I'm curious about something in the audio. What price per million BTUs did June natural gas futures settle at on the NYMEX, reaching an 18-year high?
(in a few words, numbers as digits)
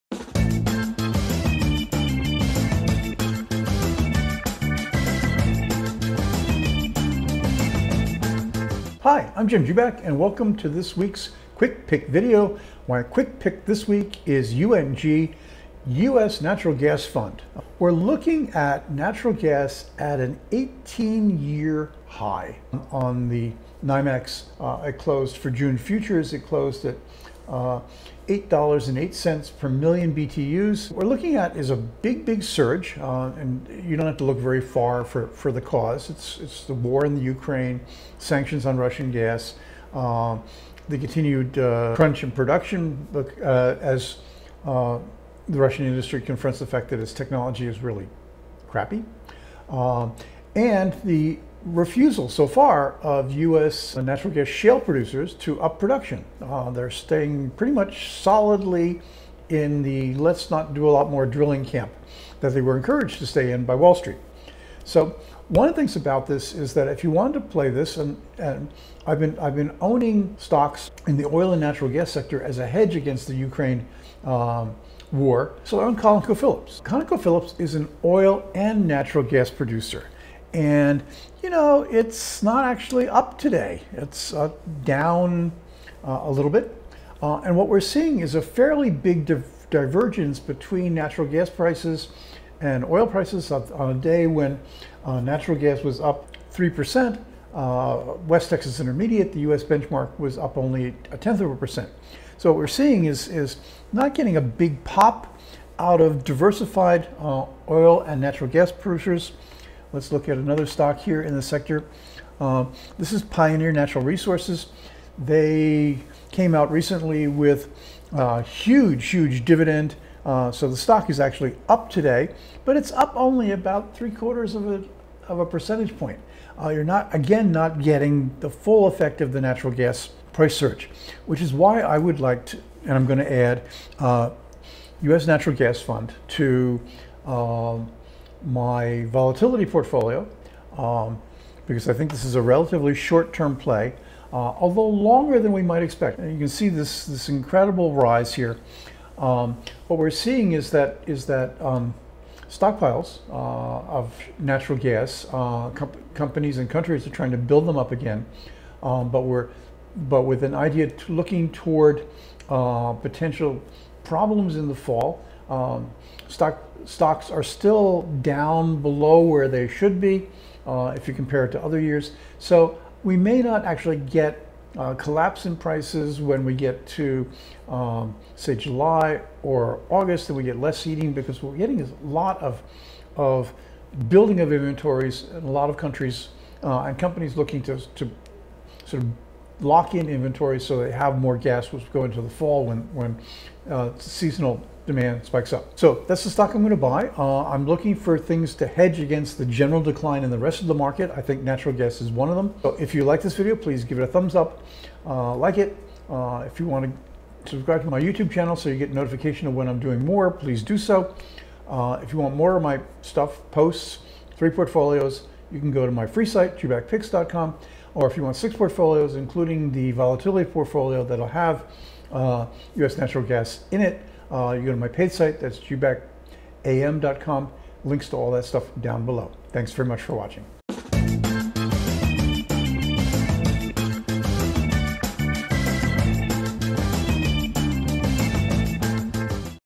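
$8.08.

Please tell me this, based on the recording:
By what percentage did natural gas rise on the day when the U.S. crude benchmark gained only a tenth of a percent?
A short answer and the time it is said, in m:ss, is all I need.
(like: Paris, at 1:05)
3%, at 1:36.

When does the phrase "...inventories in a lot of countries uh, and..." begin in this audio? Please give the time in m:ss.
3:04.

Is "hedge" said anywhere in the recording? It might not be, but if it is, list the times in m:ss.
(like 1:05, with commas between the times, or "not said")
1:12, 3:18.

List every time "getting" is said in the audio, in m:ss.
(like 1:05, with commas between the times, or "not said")
1:44, 2:07, 3:01.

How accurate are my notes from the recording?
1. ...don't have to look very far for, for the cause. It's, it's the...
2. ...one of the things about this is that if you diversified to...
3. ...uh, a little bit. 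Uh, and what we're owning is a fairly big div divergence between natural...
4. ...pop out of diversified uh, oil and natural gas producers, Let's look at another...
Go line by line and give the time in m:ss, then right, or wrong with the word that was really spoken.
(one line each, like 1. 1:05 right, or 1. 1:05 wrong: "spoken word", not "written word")
1. 0:33 right
2. 1:05 wrong: "wanted", not "diversified"
3. 1:26 wrong: "seeing", not "owning"
4. 1:44 right.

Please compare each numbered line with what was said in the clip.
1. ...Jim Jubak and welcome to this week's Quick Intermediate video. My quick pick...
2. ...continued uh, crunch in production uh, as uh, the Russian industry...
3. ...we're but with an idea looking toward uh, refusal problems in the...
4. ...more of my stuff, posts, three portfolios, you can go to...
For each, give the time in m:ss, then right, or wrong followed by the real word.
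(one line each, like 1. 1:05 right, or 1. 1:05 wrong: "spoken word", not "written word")
1. 0:09 wrong: "Pick", not "Intermediate"
2. 0:40 right
3. 2:39 wrong: "potential", not "refusal"
4. 3:32 right.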